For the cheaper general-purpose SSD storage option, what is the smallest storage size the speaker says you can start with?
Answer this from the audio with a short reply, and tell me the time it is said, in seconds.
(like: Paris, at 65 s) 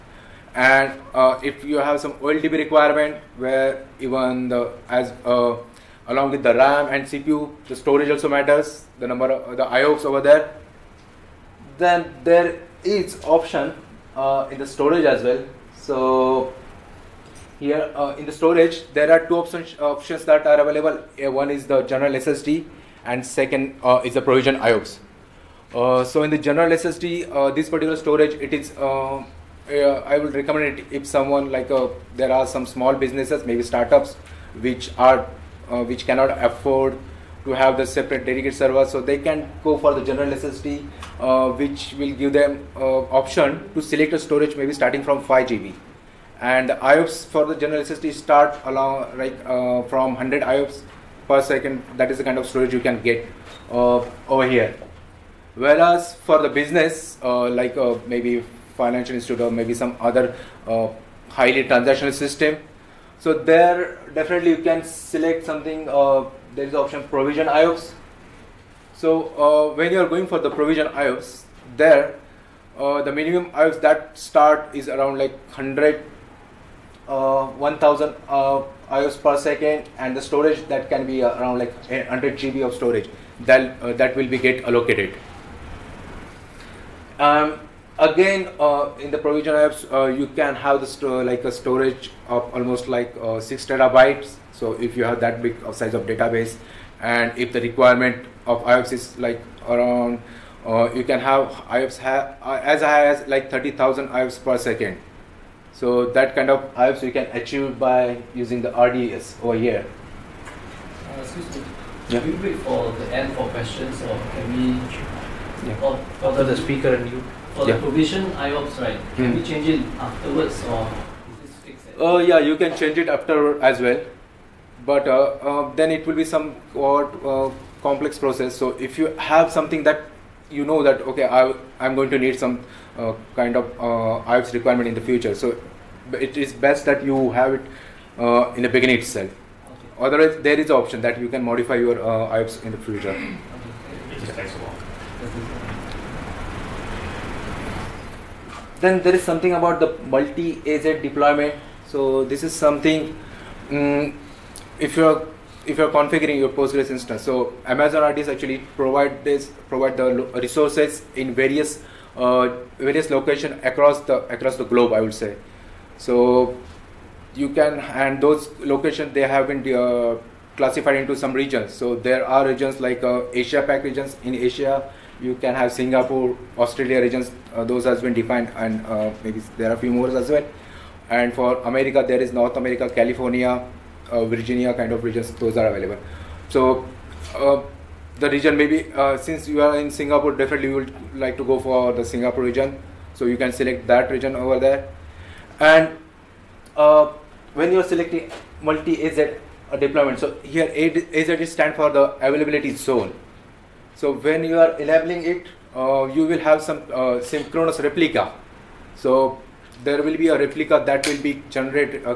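5 GB, at 45 s.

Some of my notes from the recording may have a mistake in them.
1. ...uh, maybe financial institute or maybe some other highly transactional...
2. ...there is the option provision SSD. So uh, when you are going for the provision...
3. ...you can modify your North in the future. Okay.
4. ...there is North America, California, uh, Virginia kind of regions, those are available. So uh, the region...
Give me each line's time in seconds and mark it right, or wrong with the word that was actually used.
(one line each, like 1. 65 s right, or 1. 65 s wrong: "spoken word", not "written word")
1. 57 s right
2. 66 s wrong: "IOPS", not "SSD"
3. 141 s wrong: "IOPS", not "North"
4. 182 s right.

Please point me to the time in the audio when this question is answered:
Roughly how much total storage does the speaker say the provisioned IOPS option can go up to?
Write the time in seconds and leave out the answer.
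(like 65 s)
93 s.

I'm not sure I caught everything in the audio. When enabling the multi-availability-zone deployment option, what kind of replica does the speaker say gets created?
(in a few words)
synchronous replica.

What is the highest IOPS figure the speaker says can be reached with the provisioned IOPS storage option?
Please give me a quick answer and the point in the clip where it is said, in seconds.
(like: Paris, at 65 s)
30,000 IOPS, at 103 s.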